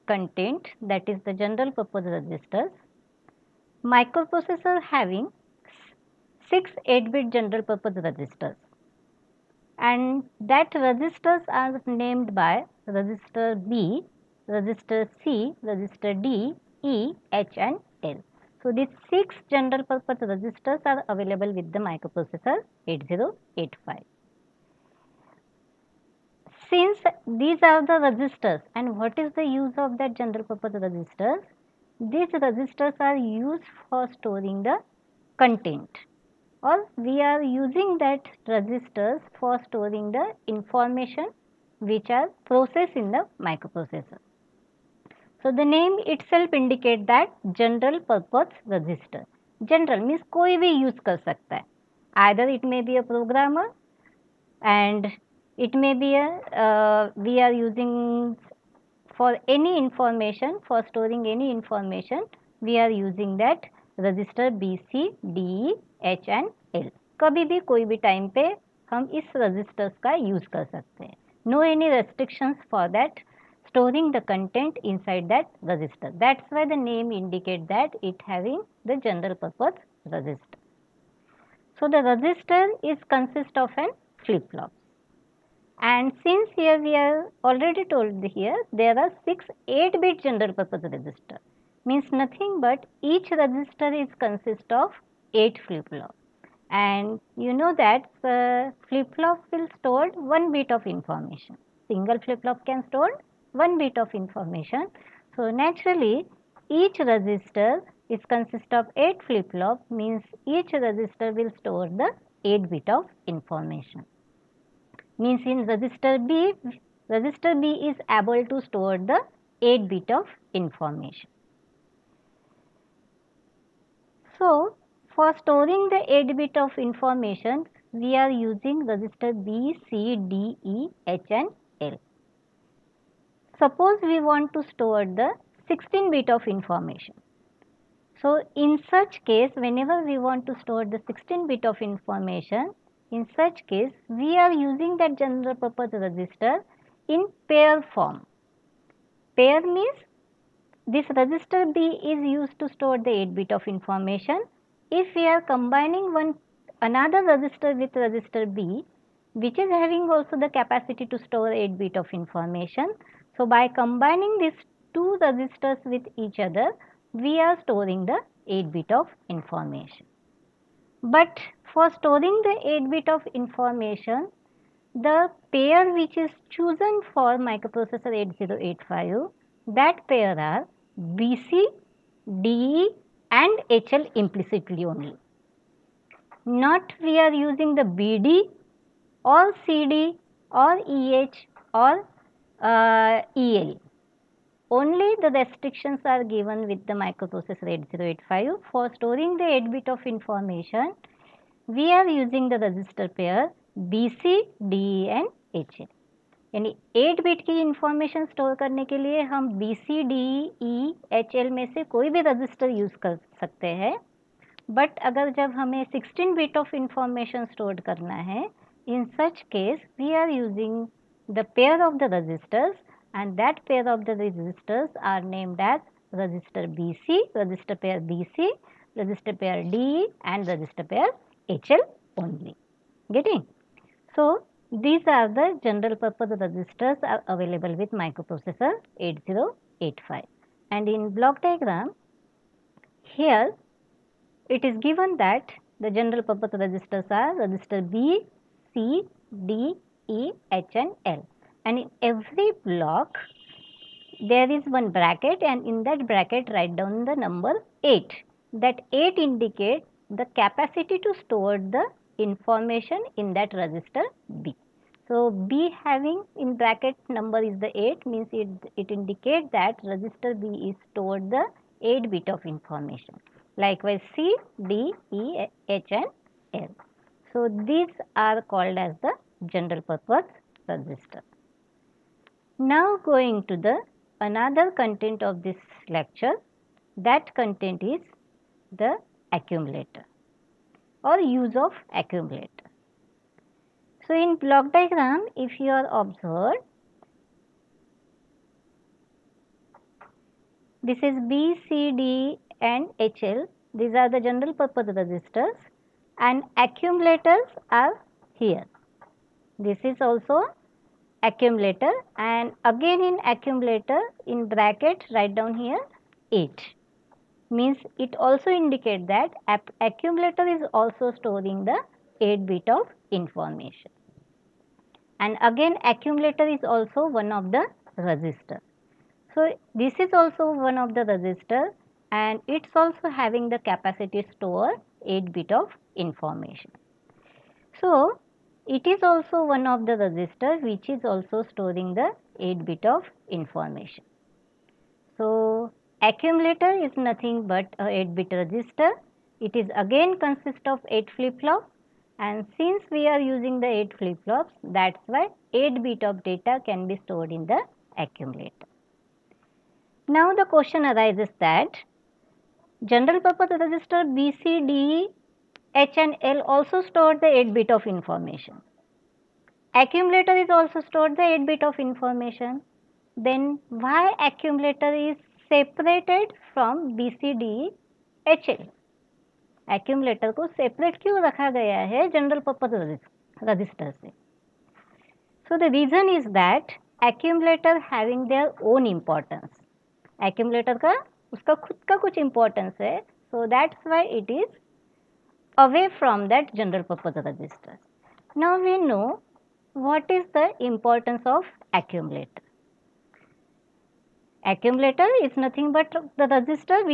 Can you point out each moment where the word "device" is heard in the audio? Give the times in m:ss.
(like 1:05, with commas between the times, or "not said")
not said.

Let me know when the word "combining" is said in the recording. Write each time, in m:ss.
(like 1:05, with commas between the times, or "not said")
2:35, 2:43.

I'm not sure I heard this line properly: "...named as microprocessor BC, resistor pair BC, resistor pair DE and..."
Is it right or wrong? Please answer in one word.
wrong.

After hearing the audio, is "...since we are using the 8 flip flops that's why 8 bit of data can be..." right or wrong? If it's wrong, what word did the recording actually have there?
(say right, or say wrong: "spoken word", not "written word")
right.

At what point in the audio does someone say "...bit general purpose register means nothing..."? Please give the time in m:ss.
1:30.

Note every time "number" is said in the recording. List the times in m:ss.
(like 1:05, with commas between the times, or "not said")
4:17, 4:27.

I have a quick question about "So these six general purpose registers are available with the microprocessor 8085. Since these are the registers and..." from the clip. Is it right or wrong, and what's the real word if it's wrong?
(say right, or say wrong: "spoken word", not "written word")
right.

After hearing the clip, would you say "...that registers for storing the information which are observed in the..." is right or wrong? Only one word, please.
wrong.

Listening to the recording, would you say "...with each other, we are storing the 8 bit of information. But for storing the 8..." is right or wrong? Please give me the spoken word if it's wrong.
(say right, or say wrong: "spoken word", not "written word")
right.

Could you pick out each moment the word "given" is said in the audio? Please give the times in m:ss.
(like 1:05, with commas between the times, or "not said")
3:16, 4:04.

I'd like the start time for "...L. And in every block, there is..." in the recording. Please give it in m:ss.
4:11.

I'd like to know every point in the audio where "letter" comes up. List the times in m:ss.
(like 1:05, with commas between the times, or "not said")
not said.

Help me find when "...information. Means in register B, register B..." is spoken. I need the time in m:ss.
1:53.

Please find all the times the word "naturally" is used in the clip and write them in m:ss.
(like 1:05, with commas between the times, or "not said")
1:45.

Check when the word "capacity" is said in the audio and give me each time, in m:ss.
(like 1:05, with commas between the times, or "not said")
2:40, 4:20, 5:33.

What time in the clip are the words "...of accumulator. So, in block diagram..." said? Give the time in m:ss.
4:51.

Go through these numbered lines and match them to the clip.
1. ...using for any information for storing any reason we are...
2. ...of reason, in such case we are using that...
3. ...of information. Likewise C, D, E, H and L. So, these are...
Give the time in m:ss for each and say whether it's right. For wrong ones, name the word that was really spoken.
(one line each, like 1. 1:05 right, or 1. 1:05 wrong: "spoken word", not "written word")
1. 0:57 wrong: "information", not "reason"
2. 2:21 wrong: "information", not "reason"
3. 4:32 right.